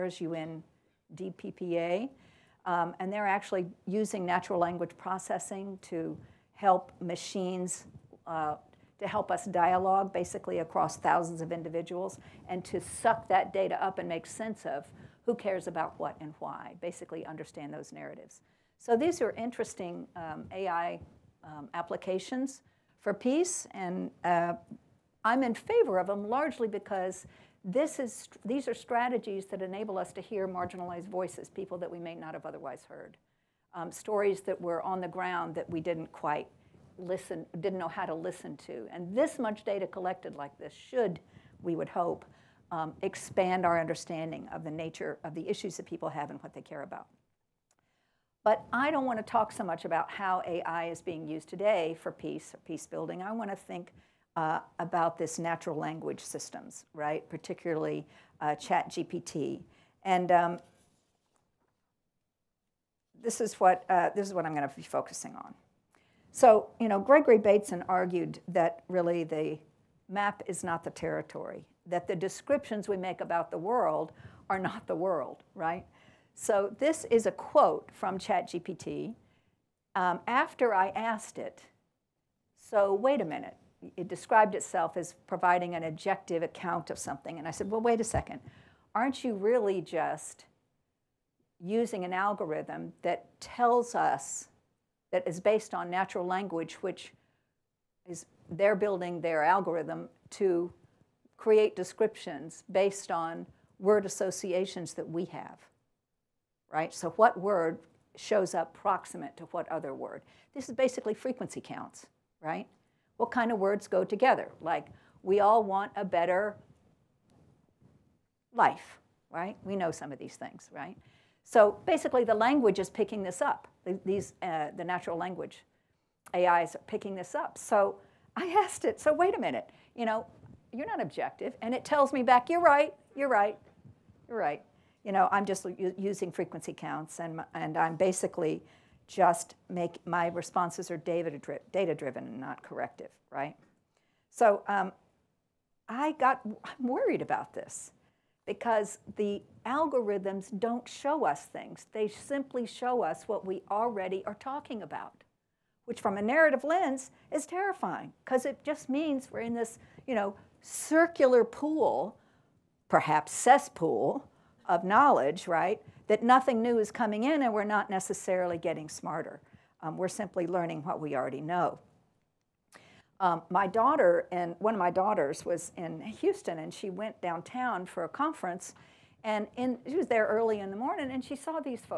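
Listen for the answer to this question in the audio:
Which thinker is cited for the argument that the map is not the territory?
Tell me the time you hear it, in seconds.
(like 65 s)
66 s.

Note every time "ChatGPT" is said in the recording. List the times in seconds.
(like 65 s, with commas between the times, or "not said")
58 s, 78 s.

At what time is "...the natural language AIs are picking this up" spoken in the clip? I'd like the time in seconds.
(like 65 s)
124 s.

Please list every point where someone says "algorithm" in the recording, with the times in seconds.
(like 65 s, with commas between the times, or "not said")
92 s, 99 s, 149 s.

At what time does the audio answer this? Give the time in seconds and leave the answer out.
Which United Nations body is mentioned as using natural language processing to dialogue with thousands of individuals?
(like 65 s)
0 s.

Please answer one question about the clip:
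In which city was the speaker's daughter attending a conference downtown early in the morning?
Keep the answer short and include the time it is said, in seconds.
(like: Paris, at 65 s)
Houston, at 176 s.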